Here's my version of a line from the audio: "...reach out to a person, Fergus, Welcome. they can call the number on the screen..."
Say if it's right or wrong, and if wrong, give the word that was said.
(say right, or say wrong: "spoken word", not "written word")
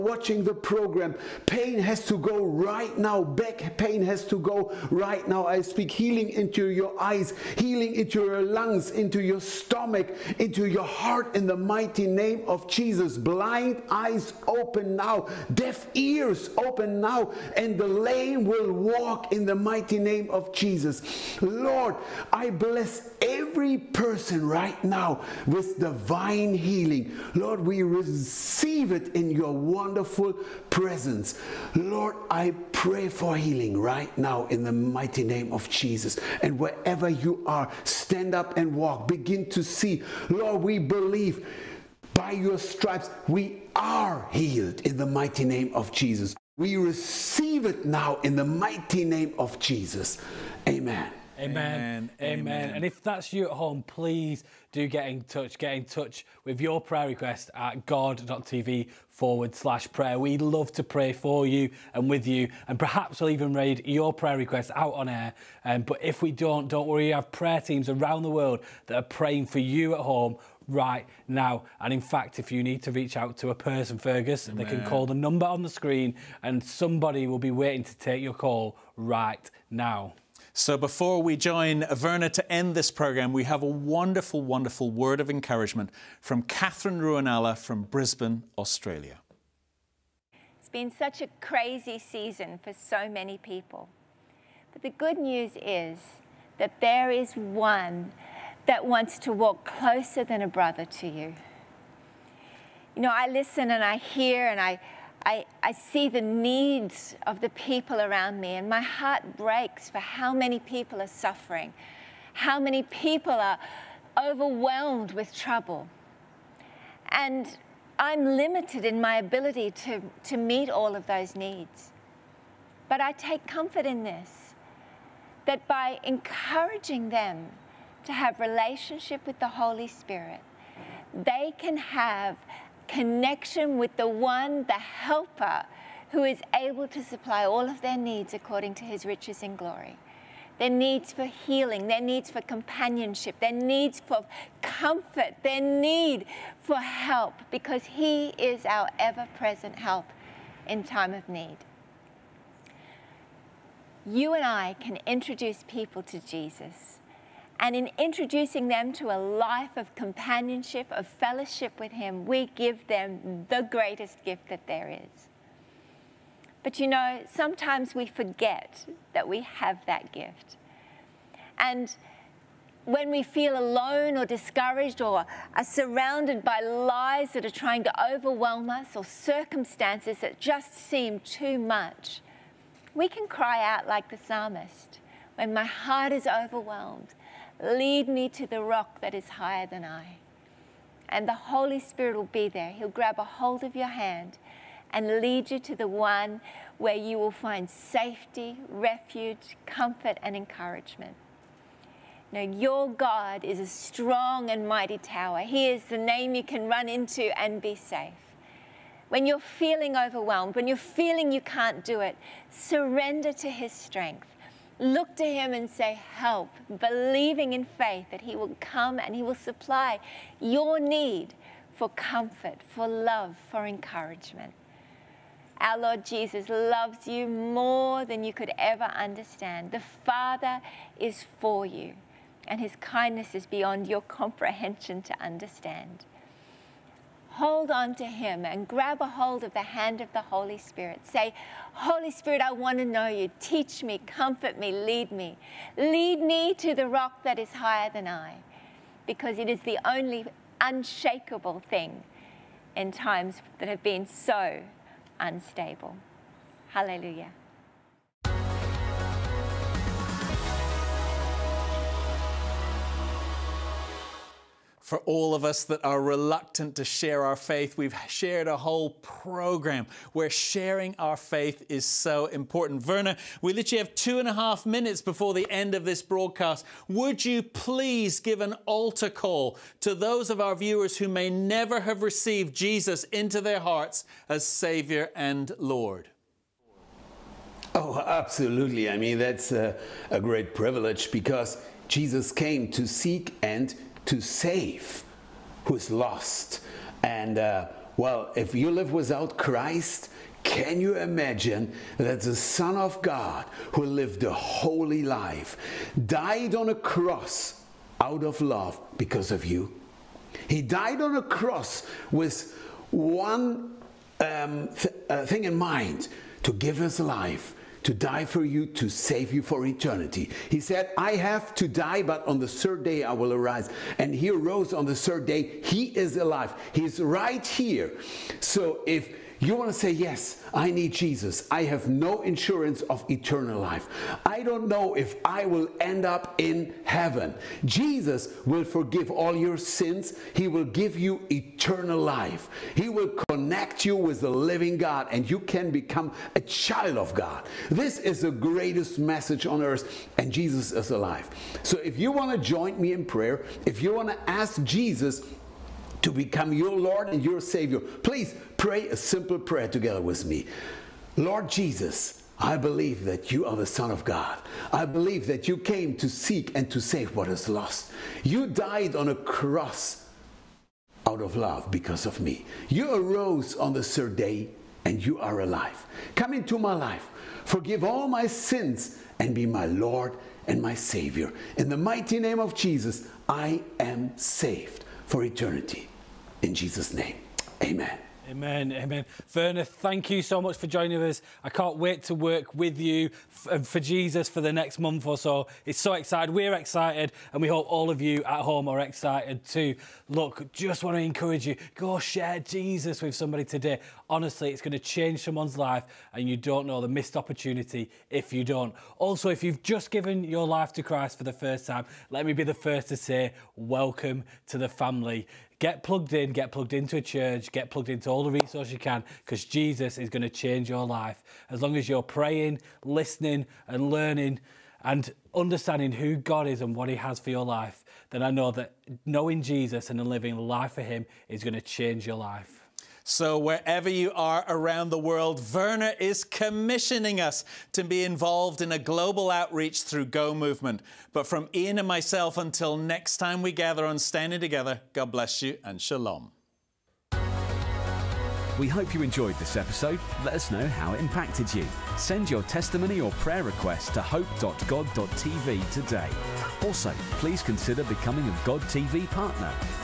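wrong: "Amen", not "Welcome".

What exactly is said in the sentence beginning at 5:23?
And he arose on the third day.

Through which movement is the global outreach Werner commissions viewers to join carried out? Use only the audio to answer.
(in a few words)
Go Movement.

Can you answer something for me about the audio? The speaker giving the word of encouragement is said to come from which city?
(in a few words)
Brisbane.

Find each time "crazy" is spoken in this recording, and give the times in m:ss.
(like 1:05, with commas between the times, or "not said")
1:31.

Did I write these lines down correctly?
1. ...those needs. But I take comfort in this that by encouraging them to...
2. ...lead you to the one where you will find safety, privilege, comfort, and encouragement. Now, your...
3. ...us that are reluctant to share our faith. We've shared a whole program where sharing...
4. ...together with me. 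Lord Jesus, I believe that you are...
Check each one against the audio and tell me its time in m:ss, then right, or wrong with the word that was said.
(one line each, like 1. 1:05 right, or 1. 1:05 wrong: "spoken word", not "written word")
1. 2:01 right
2. 3:15 wrong: "refuge", not "privilege"
3. 4:25 right
4. 5:59 right.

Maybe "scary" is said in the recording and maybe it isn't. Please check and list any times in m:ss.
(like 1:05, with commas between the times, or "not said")
not said.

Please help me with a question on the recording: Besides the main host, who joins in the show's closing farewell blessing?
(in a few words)
Ian.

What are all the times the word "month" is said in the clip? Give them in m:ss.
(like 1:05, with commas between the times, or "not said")
6:34.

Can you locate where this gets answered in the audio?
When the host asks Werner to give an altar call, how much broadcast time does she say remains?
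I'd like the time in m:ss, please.
4:33.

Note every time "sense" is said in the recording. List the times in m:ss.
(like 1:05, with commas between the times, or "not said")
not said.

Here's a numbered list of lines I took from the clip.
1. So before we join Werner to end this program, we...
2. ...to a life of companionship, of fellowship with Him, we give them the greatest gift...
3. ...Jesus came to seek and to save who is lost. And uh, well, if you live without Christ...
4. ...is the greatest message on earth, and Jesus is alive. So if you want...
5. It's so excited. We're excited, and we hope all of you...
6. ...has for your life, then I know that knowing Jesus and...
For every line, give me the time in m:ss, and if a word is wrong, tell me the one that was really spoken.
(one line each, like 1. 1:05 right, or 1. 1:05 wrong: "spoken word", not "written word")
1. 1:20 right
2. 2:38 right
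3. 4:51 right
4. 5:47 right
5. 6:35 right
6. 7:06 right.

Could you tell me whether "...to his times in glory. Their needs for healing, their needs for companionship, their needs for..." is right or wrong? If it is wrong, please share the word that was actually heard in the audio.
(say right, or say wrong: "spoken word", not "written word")
wrong: "riches", not "times".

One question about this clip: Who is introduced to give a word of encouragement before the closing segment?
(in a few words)
Katherine Ruonala.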